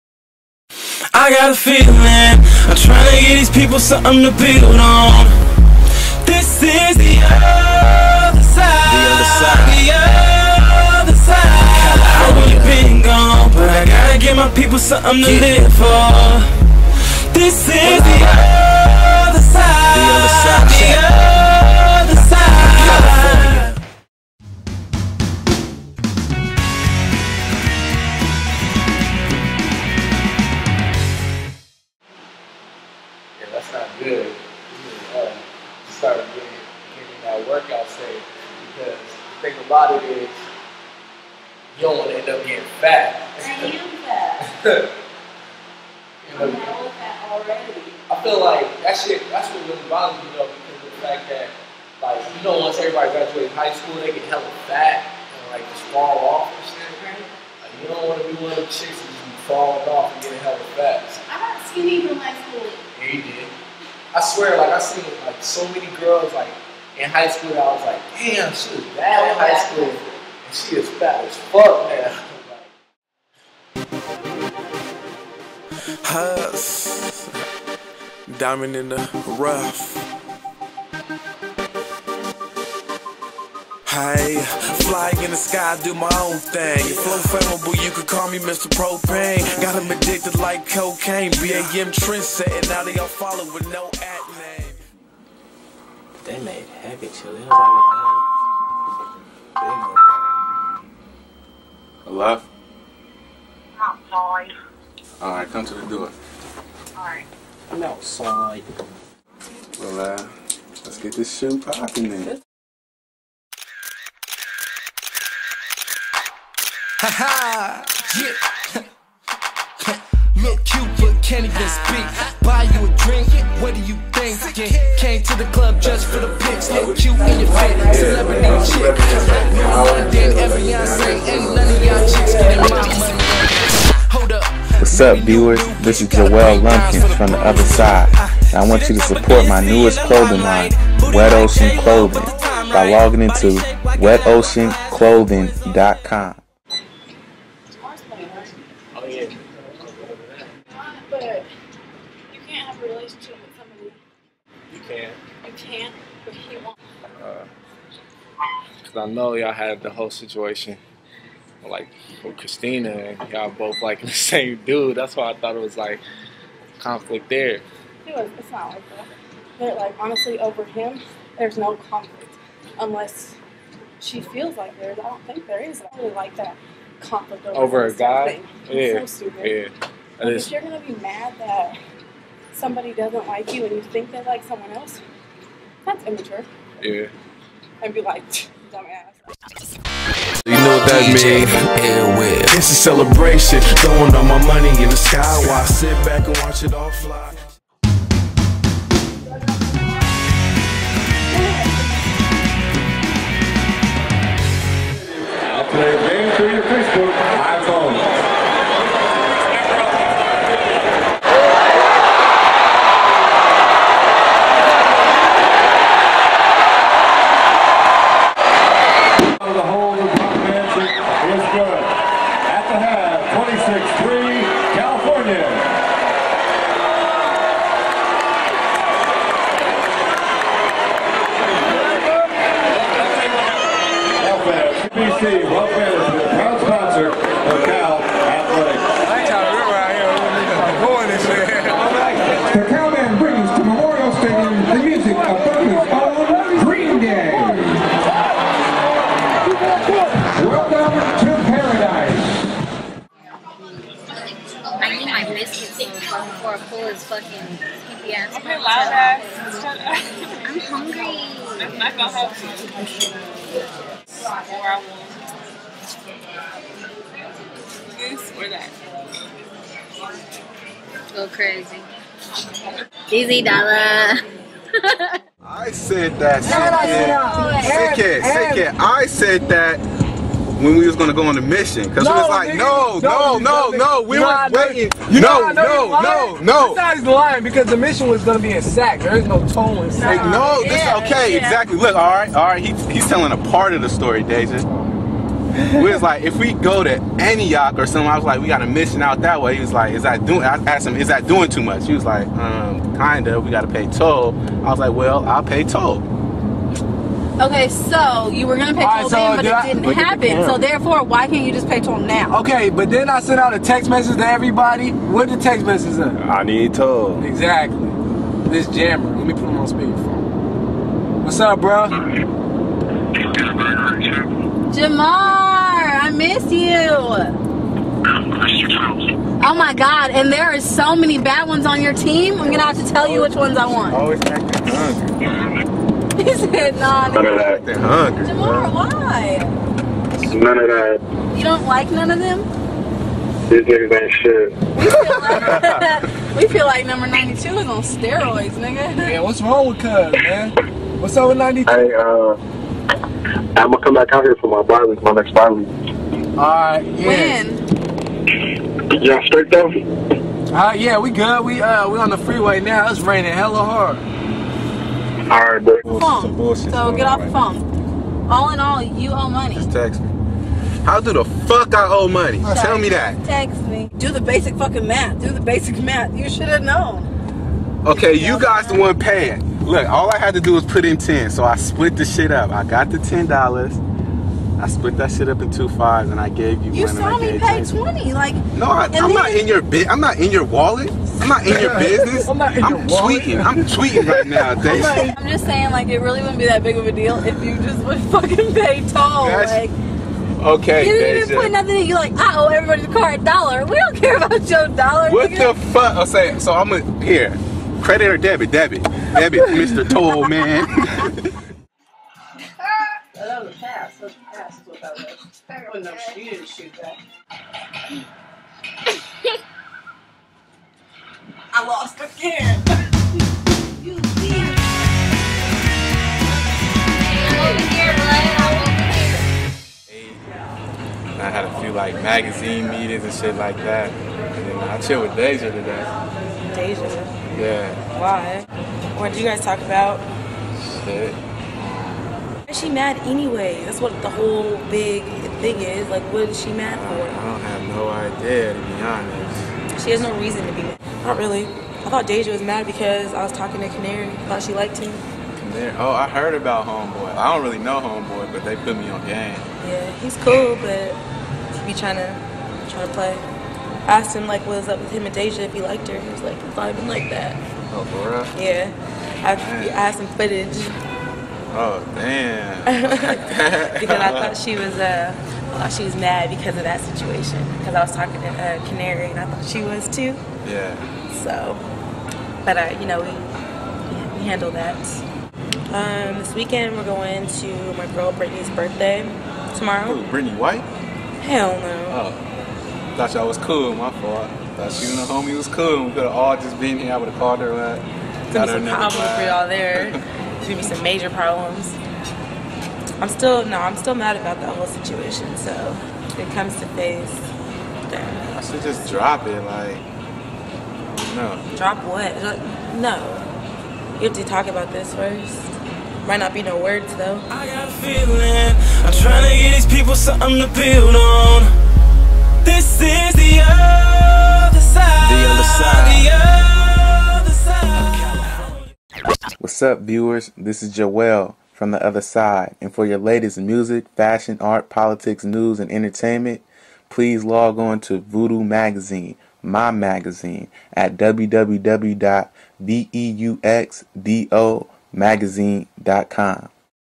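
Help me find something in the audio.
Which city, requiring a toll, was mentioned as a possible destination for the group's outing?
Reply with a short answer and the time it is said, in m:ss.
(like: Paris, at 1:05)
Antioch, at 4:57.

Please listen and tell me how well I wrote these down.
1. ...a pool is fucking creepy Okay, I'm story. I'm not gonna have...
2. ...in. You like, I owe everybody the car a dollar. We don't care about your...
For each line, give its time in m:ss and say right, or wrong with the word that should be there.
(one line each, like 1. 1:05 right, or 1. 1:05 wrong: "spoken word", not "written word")
1. 4:16 wrong: "hungry", not "story"
2. 6:41 right.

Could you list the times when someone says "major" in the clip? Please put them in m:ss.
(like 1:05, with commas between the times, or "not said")
8:20.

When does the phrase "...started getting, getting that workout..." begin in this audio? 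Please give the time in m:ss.
0:35.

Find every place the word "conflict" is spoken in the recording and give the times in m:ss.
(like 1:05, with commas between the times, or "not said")
2:46, 2:51, 2:56.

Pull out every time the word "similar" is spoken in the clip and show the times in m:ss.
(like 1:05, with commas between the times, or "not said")
not said.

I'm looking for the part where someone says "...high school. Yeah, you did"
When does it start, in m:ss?
1:02.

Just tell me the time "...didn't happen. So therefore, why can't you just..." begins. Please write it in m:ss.
5:09.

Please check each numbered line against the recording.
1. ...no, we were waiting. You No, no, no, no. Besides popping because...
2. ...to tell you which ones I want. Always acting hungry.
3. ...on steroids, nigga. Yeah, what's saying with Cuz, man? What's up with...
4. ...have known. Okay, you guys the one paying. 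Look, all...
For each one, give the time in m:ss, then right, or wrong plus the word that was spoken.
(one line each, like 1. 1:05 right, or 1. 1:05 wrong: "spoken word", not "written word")
1. 4:43 wrong: "lying", not "popping"
2. 5:32 right
3. 5:47 wrong: "wrong", not "saying"
4. 6:16 right.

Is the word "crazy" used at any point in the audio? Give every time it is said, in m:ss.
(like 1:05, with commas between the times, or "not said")
4:31.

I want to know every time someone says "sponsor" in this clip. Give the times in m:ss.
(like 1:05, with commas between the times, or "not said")
3:56.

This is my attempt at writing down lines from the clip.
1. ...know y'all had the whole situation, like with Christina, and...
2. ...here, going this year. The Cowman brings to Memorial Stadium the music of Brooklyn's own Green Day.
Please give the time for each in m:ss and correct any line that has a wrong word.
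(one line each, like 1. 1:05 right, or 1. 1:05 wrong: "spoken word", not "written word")
1. 2:39 right
2. 4:00 right.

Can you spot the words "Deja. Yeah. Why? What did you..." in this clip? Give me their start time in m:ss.
7:16.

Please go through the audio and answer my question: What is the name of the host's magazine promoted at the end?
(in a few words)
Voodoo Magazine.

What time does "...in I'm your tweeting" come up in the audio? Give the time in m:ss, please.
6:32.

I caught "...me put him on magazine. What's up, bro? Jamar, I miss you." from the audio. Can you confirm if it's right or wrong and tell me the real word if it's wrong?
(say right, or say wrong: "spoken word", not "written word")
wrong: "speakerphone", not "magazine".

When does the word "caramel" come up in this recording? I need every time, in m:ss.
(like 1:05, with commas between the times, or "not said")
not said.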